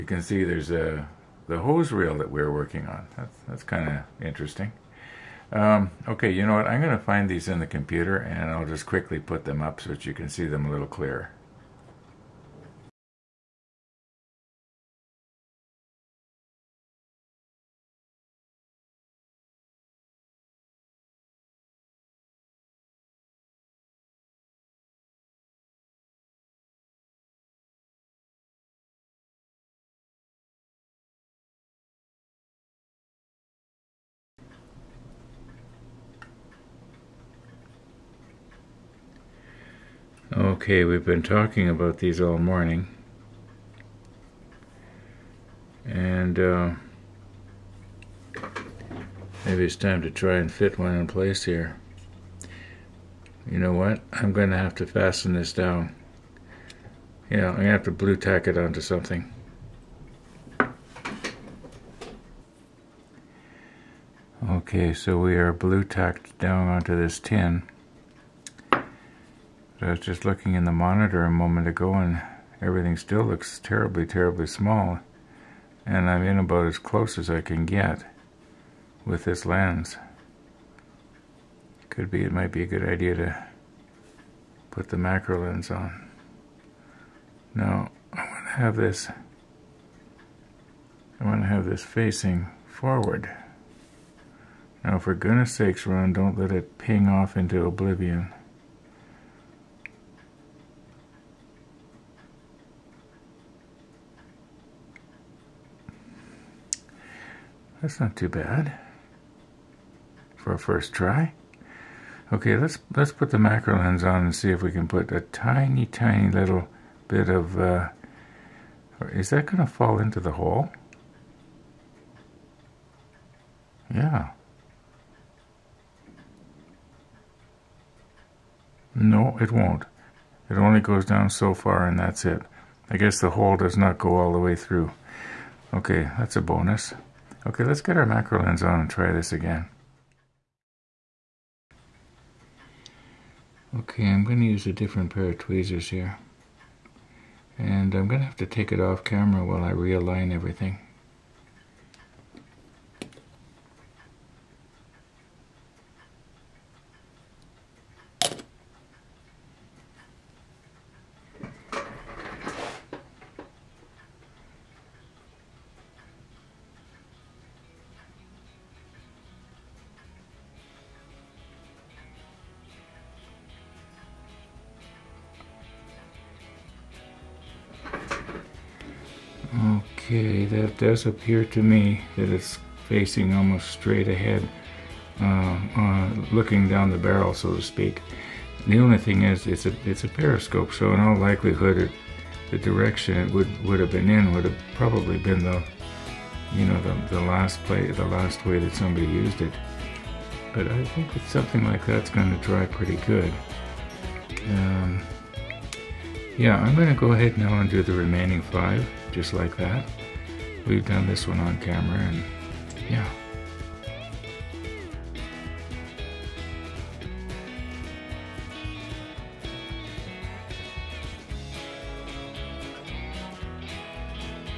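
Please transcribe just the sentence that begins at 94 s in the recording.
Now, for goodness sakes, Ron, don't let it ping off into oblivion.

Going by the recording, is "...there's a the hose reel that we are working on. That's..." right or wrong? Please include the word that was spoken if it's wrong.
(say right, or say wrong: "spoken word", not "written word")
right.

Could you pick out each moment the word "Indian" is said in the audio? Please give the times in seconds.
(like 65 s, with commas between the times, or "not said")
not said.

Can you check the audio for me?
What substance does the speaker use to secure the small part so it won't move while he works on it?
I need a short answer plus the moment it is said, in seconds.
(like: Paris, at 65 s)
blue tack, at 57 s.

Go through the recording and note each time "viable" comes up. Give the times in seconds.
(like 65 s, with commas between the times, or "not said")
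not said.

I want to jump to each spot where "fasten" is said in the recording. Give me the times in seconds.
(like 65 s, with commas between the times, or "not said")
54 s.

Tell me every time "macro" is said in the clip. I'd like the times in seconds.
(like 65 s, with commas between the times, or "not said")
84 s, 113 s, 138 s.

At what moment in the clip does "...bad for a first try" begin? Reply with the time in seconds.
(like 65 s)
108 s.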